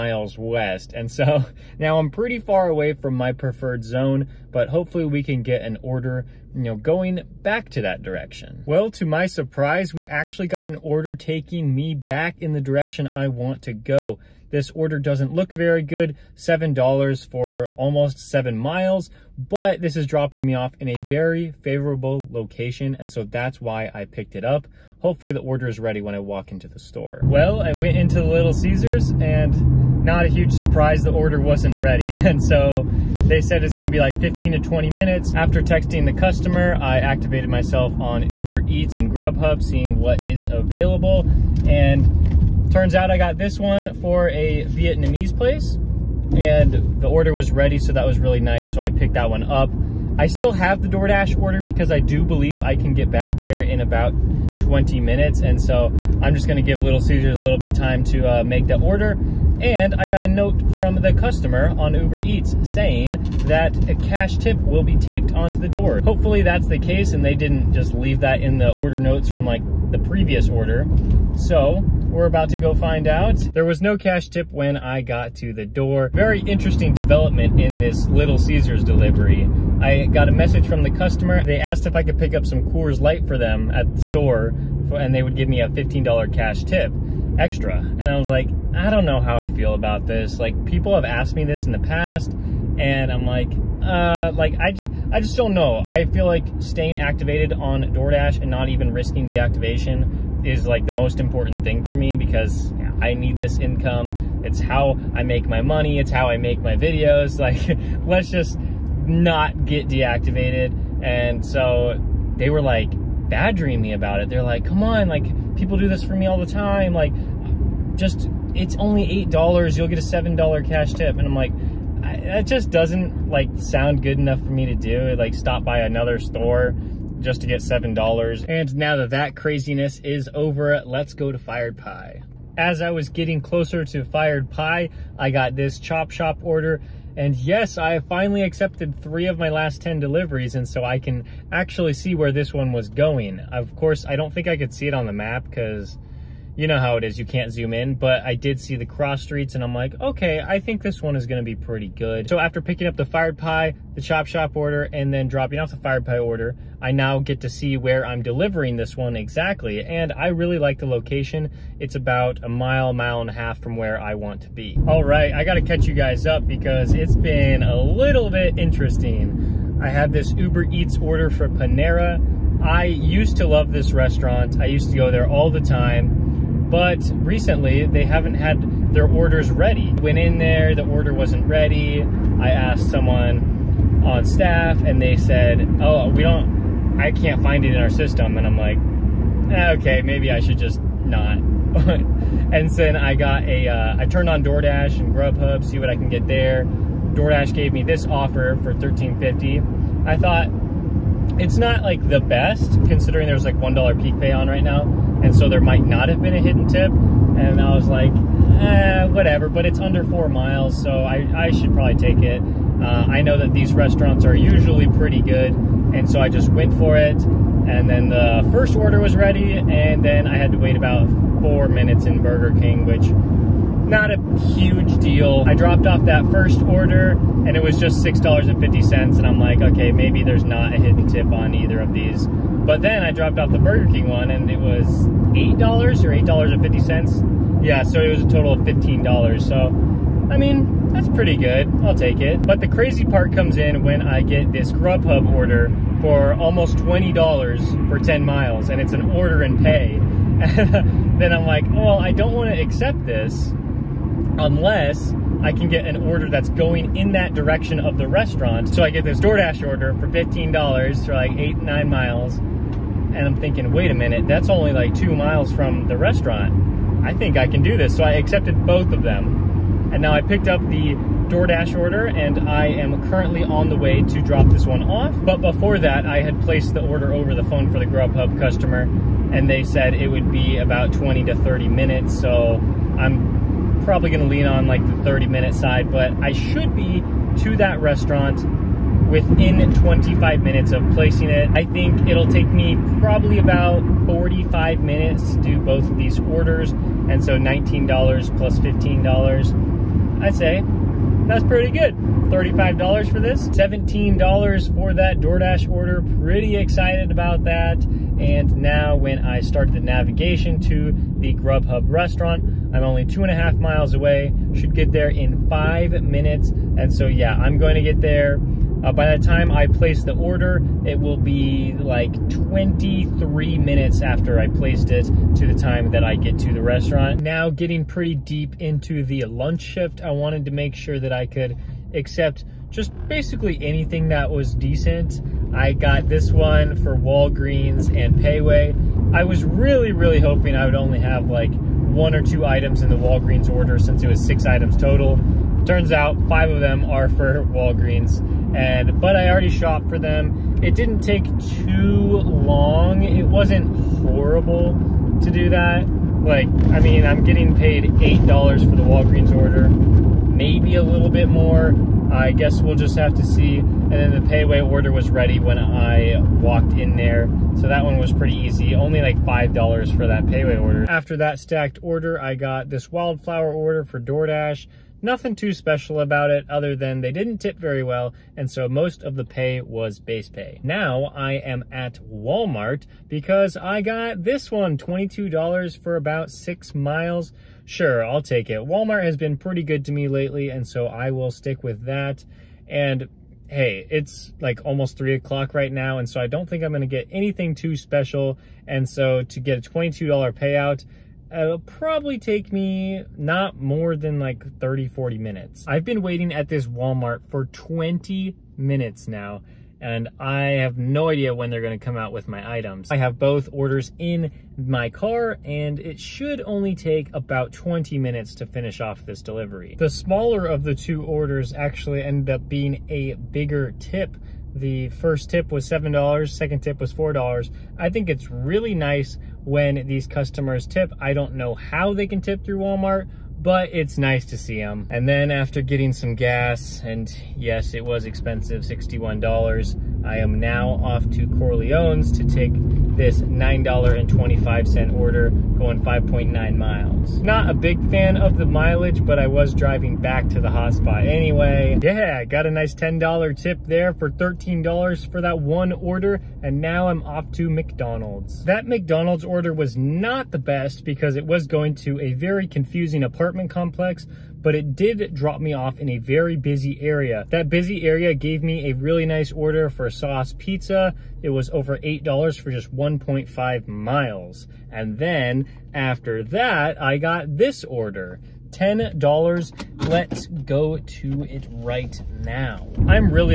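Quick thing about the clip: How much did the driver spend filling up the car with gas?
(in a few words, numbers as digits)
$61.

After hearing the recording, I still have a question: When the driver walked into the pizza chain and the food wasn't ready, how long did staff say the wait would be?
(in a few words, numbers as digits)
15 to 20 minutes.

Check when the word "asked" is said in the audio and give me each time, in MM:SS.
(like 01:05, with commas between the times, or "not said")
01:21, 01:31, 03:02.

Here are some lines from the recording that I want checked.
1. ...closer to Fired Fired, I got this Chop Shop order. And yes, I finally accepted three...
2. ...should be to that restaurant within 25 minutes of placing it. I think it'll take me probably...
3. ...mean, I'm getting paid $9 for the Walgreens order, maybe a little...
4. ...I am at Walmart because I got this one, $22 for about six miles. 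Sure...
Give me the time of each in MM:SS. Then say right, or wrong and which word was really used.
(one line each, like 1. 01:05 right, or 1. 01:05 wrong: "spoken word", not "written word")
1. 02:13 wrong: "Pie", not "Fired"
2. 04:46 right
3. 05:56 wrong: "8", not "9"
4. 06:21 right.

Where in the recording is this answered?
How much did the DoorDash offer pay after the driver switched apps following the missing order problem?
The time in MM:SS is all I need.
03:18.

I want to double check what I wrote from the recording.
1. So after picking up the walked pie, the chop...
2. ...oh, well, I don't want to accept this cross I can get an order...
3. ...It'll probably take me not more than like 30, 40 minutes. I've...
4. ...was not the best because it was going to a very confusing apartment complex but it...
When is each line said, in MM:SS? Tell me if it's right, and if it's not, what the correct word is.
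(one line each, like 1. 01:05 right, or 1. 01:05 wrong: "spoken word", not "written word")
1. 02:32 wrong: "fired", not "walked"
2. 04:11 wrong: "unless", not "cross"
3. 06:41 right
4. 07:39 right.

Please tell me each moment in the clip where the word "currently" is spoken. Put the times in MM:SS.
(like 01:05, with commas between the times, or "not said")
04:33.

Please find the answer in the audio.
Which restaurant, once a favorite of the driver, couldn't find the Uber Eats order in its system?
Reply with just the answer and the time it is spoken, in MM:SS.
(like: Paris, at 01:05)
Panera, at 02:51.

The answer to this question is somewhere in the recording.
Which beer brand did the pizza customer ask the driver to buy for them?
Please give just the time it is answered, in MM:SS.
01:22.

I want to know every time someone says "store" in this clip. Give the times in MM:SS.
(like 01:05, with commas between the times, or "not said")
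00:26, 01:24, 02:06.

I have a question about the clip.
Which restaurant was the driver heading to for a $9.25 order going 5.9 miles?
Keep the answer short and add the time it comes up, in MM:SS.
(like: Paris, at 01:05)
Corleone's, at 07:21.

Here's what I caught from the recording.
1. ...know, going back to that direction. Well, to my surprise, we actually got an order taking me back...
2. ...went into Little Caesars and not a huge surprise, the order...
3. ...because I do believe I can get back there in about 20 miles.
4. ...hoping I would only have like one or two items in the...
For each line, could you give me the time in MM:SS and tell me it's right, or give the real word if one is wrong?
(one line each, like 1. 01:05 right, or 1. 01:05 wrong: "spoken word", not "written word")
1. 00:06 right
2. 00:27 right
3. 00:51 wrong: "minutes", not "miles"
4. 05:40 right.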